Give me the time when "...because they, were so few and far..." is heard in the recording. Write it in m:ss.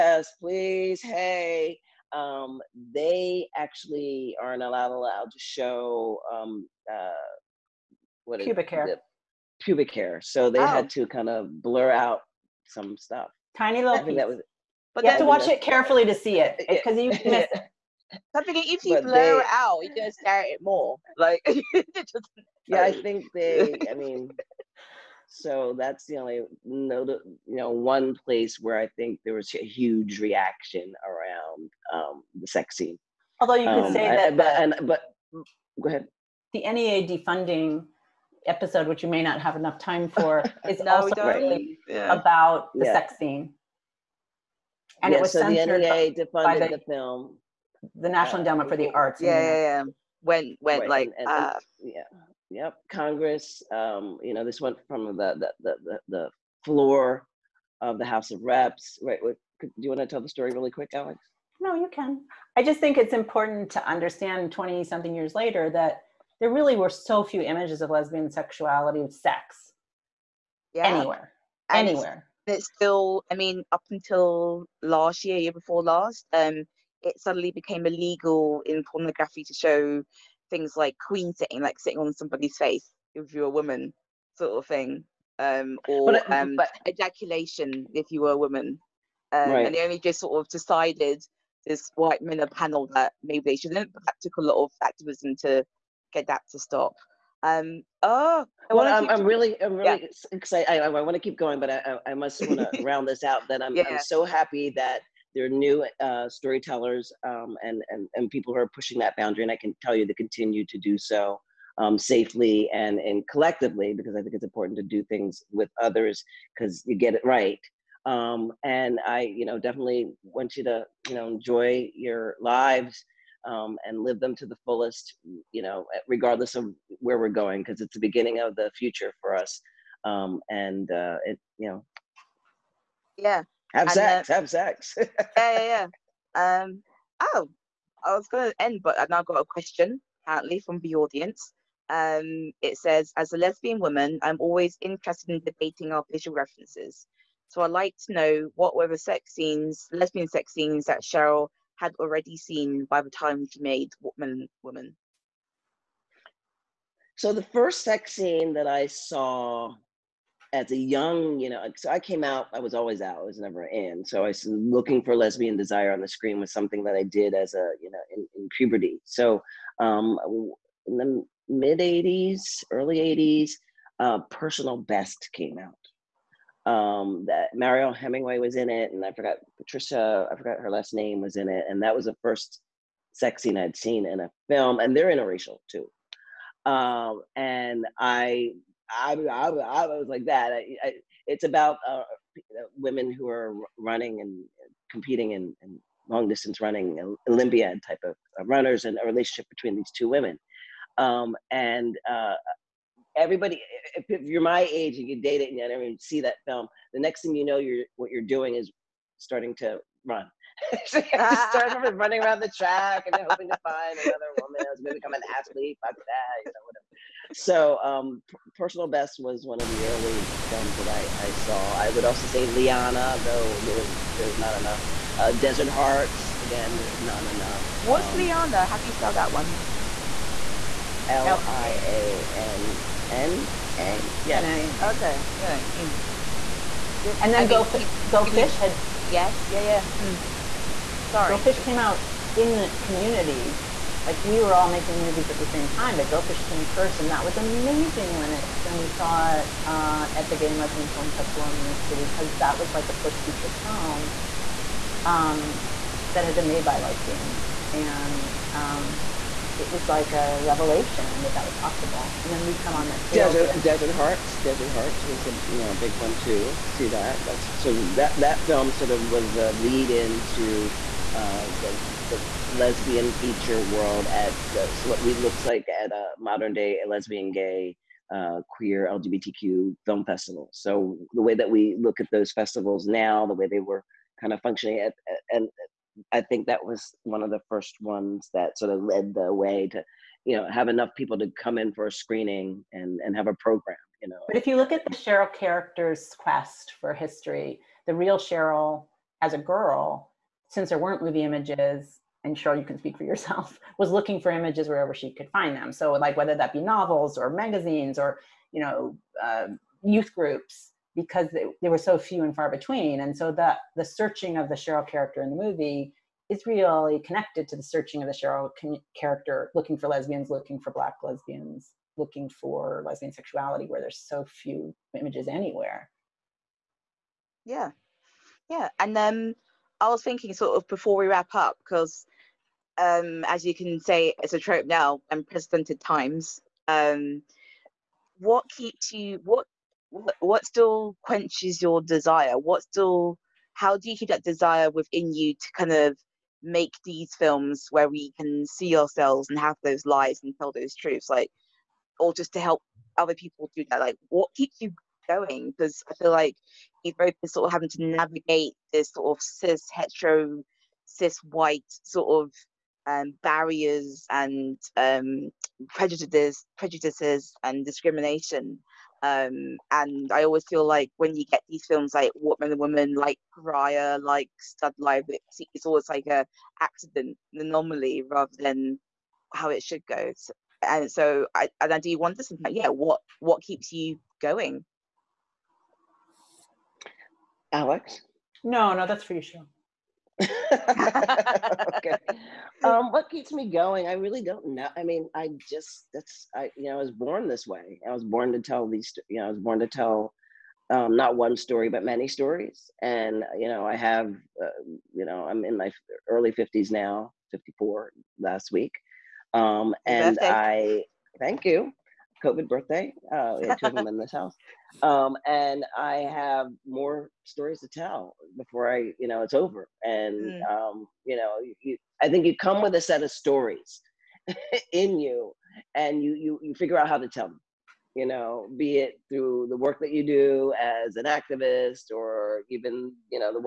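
5:10.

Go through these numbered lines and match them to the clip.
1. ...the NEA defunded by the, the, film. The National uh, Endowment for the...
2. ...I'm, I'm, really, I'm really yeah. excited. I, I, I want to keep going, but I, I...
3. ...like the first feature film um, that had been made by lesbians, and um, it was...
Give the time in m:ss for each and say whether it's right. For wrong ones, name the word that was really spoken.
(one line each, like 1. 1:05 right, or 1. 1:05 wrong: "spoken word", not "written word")
1. 0:45 right
2. 1:39 right
3. 4:12 right.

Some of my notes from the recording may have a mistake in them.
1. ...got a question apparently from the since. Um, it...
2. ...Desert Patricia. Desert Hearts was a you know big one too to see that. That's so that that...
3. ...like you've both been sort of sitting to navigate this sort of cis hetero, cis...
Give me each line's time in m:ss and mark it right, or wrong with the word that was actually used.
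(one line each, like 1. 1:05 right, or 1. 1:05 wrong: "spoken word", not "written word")
1. 2:19 wrong: "audience", not "since"
2. 4:23 wrong: "Hearts", not "Patricia"
3. 5:56 wrong: "having", not "sitting".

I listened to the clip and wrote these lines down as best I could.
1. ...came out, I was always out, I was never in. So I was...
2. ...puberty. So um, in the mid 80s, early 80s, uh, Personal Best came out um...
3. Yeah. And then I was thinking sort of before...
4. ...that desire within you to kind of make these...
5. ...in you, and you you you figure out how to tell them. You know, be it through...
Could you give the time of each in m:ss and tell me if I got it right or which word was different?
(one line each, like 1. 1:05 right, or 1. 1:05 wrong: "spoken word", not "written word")
1. 2:41 right
2. 2:48 right
3. 5:28 right
4. 5:44 right
5. 7:04 right.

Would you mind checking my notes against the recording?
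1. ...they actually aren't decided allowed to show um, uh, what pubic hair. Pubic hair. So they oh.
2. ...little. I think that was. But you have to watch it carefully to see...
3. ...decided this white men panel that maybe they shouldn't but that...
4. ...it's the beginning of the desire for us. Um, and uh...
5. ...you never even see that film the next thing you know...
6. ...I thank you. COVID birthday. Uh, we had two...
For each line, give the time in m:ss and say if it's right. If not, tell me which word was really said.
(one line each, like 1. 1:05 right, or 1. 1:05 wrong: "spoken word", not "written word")
1. 0:02 wrong: "allowed", not "decided"
2. 0:13 right
3. 1:30 right
4. 2:07 wrong: "future", not "desire"
5. 3:25 right
6. 6:50 right.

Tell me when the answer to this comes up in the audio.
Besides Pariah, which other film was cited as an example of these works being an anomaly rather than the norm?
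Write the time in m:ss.
6:14.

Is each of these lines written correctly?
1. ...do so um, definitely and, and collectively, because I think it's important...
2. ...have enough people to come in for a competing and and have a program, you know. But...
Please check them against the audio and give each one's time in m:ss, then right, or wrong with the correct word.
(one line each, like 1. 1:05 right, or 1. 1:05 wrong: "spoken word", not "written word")
1. 1:50 wrong: "safely", not "definitely"
2. 4:50 wrong: "screening", not "competing".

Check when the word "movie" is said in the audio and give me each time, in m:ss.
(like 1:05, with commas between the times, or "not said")
4:05, 5:01, 5:15.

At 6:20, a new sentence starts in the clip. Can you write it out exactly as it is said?
So, and so I and I do wonder sometimes, yeah, what what keeps you going?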